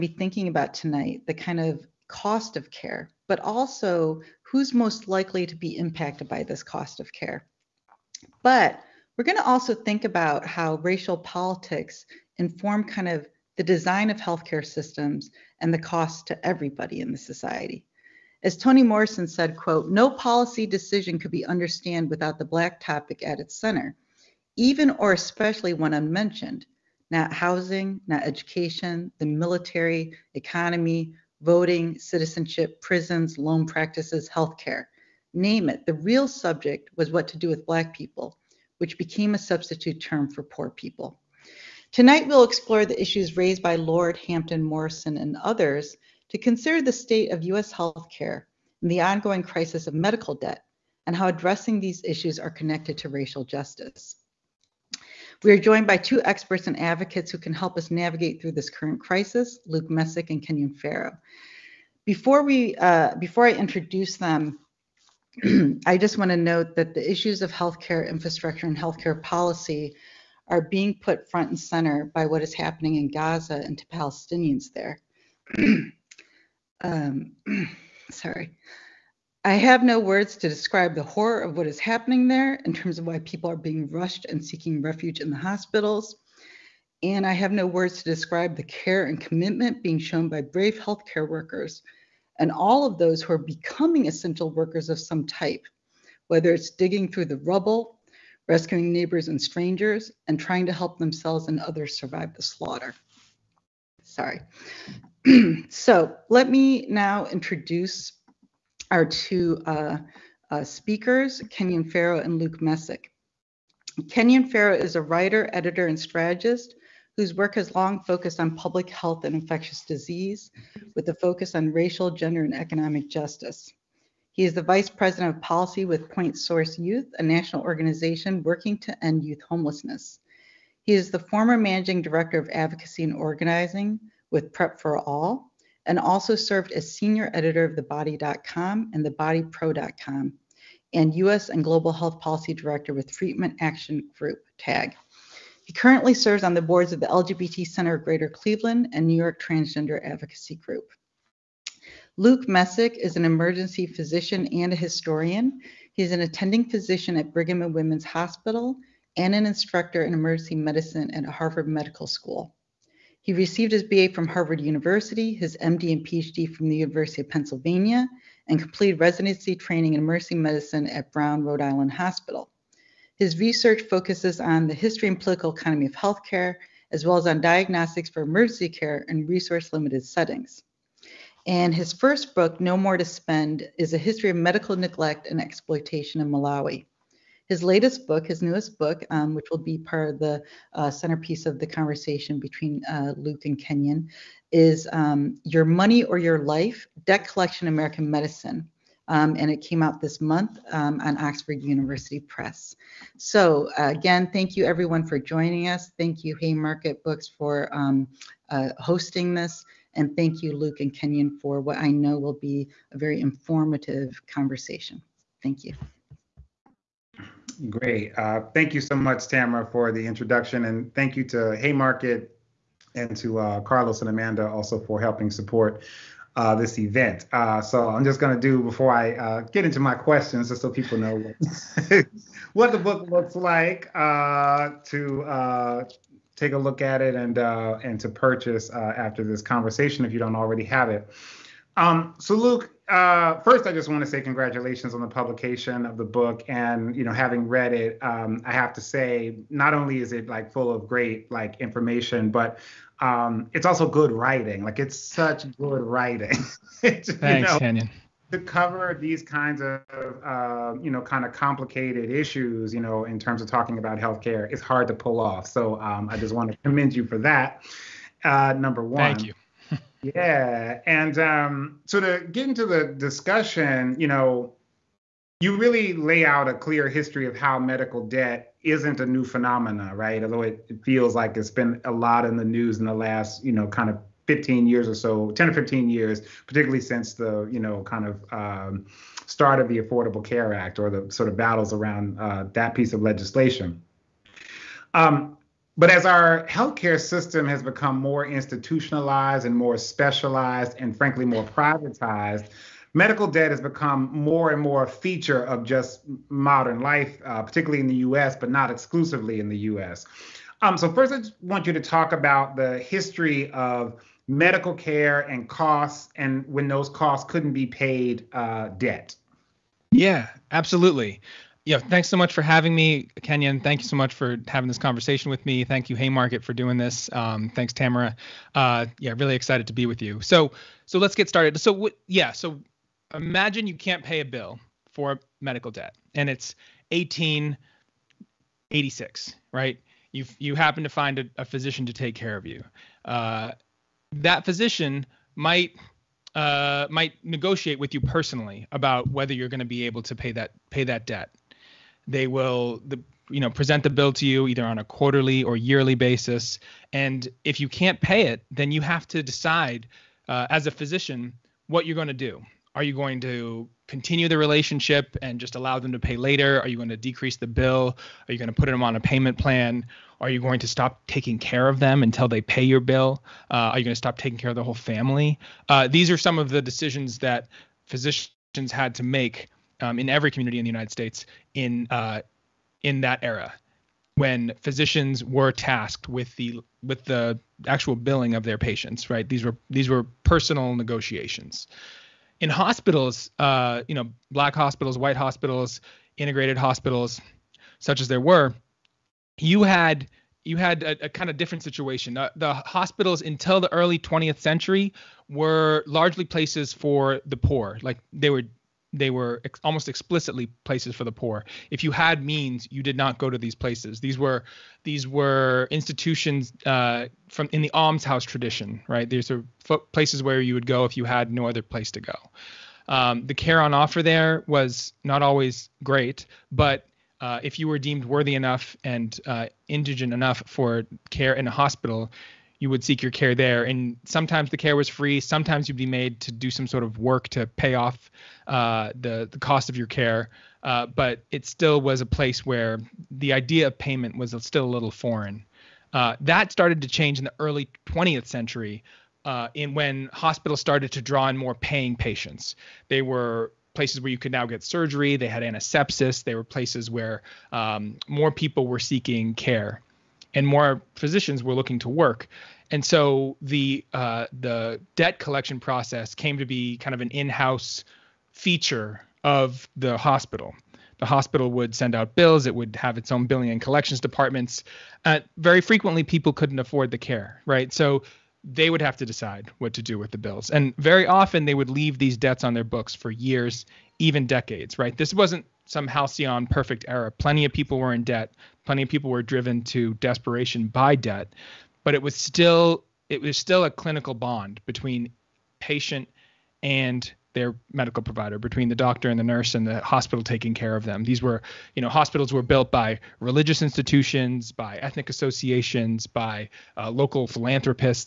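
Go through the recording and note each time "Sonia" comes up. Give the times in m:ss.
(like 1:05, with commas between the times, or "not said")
not said.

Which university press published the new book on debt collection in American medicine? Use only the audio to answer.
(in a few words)
Oxford University Press.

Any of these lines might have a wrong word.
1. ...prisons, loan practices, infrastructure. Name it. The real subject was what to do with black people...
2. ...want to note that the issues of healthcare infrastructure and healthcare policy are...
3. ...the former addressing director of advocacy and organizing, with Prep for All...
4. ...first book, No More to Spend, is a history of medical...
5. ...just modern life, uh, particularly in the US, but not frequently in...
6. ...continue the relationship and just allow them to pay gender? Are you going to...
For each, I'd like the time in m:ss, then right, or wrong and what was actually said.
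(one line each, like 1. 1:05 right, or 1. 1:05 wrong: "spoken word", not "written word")
1. 0:32 wrong: "healthcare", not "infrastructure"
2. 1:06 right
3. 2:11 wrong: "managing", not "addressing"
4. 3:01 right
5. 5:05 wrong: "exclusively", not "frequently"
6. 6:03 wrong: "later", not "gender".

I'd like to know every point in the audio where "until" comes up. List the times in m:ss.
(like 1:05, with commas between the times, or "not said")
6:12, 6:43.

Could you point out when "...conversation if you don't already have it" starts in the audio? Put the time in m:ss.
3:59.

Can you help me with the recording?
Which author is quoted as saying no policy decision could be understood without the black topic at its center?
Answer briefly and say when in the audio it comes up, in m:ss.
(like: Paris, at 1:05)
Toni Morrison, at 0:18.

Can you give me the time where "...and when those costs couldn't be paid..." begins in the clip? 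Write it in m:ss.
5:16.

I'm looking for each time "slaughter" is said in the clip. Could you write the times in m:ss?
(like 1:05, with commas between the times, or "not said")
1:42.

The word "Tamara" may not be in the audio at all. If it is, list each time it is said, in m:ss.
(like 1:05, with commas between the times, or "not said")
3:39, 5:27.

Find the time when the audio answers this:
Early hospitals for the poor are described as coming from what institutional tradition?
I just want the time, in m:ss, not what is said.
6:57.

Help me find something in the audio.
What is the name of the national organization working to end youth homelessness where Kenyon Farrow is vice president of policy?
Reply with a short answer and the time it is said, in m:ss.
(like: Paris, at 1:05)
Point Source Youth, at 2:06.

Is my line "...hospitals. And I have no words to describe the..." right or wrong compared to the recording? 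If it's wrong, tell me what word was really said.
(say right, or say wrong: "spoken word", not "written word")
right.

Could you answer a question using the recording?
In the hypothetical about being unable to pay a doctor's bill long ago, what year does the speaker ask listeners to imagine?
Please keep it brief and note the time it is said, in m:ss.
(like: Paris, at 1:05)
1886, at 5:36.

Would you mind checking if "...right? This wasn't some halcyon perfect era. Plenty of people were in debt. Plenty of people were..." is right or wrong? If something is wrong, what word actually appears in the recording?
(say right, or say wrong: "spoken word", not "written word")
right.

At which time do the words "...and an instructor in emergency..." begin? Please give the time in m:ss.
2:39.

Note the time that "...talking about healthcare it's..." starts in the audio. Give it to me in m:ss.
4:23.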